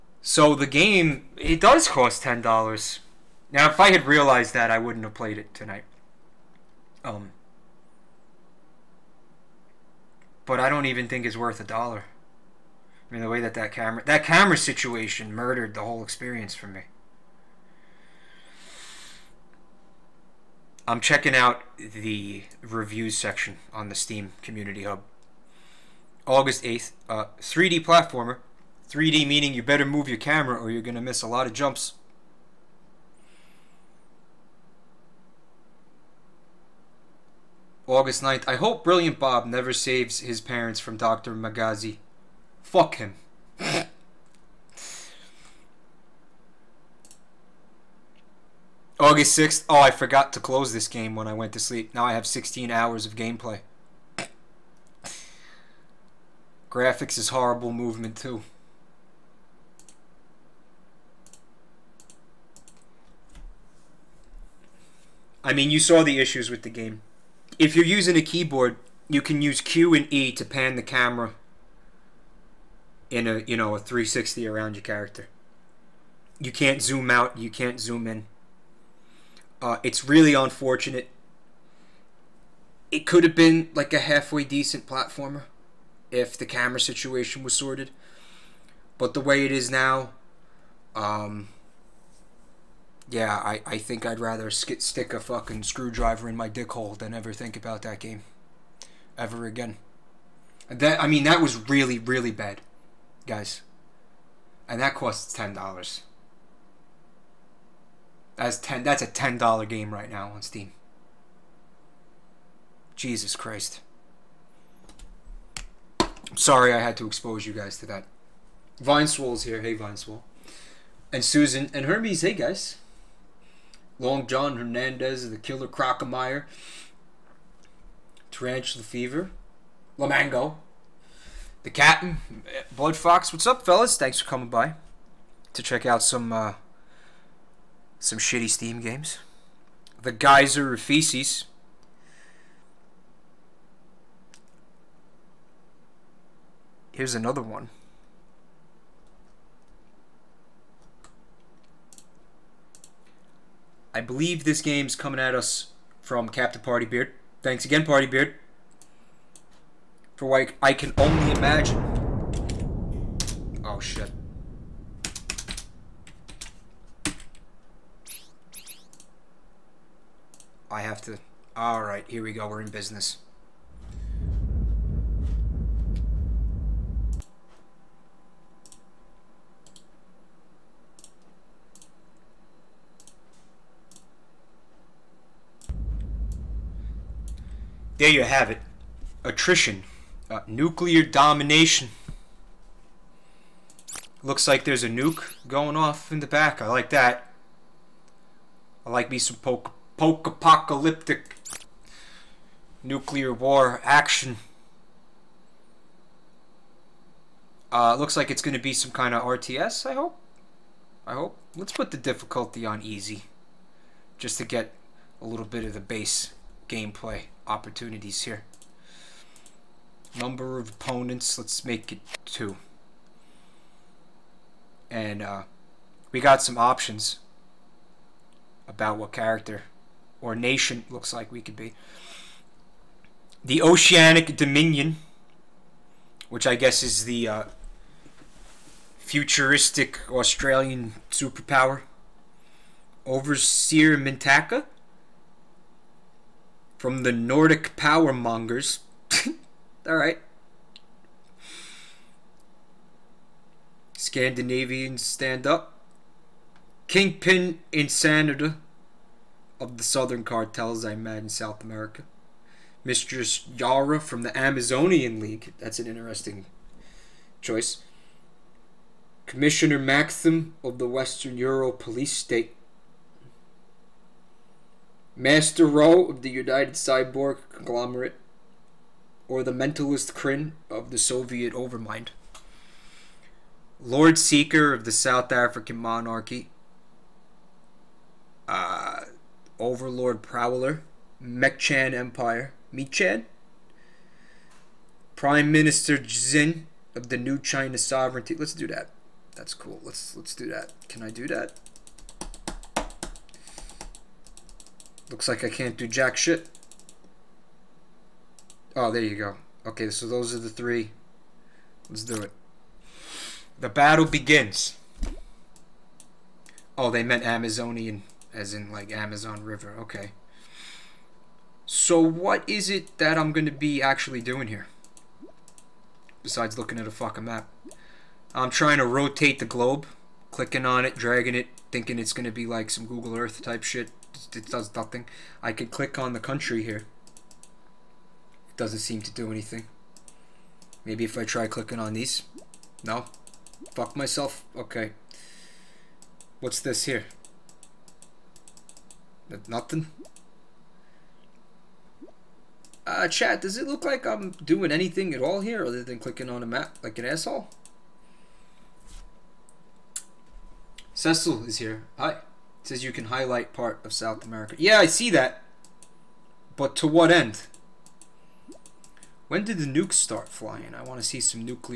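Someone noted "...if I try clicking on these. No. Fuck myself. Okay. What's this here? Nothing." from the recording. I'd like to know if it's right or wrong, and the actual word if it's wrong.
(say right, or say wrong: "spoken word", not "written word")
right.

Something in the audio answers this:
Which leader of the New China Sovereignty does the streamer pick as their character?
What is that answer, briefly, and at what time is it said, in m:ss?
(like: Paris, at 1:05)
Prime Minister Xin, at 4:55.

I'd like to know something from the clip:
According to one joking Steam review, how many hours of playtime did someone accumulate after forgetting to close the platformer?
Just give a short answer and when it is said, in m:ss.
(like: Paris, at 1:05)
16, at 0:52.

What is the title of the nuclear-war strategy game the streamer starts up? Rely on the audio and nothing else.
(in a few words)
Attrition.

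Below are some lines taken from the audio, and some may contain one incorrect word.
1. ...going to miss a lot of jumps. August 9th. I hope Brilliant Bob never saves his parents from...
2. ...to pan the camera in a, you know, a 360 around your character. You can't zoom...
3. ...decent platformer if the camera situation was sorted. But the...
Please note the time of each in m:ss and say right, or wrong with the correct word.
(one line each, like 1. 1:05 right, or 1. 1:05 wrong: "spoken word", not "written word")
1. 0:30 right
2. 1:10 right
3. 1:24 right.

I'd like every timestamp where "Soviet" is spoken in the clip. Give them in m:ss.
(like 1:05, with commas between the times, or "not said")
4:40.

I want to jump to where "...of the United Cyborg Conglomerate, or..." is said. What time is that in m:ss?
4:36.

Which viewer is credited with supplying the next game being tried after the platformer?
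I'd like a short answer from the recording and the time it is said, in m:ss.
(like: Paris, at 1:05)
Captain Party Beard, at 2:36.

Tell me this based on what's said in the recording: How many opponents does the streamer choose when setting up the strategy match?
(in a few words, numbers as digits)
2.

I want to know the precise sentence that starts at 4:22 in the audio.
Mistress Yara from the Amazonian League.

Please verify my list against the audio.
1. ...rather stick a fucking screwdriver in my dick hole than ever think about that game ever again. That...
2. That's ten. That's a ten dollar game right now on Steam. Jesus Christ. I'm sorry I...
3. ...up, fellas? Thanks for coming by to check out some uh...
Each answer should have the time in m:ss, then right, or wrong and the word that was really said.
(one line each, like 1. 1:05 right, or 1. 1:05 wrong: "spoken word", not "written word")
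1. 1:34 right
2. 1:48 right
3. 2:13 right.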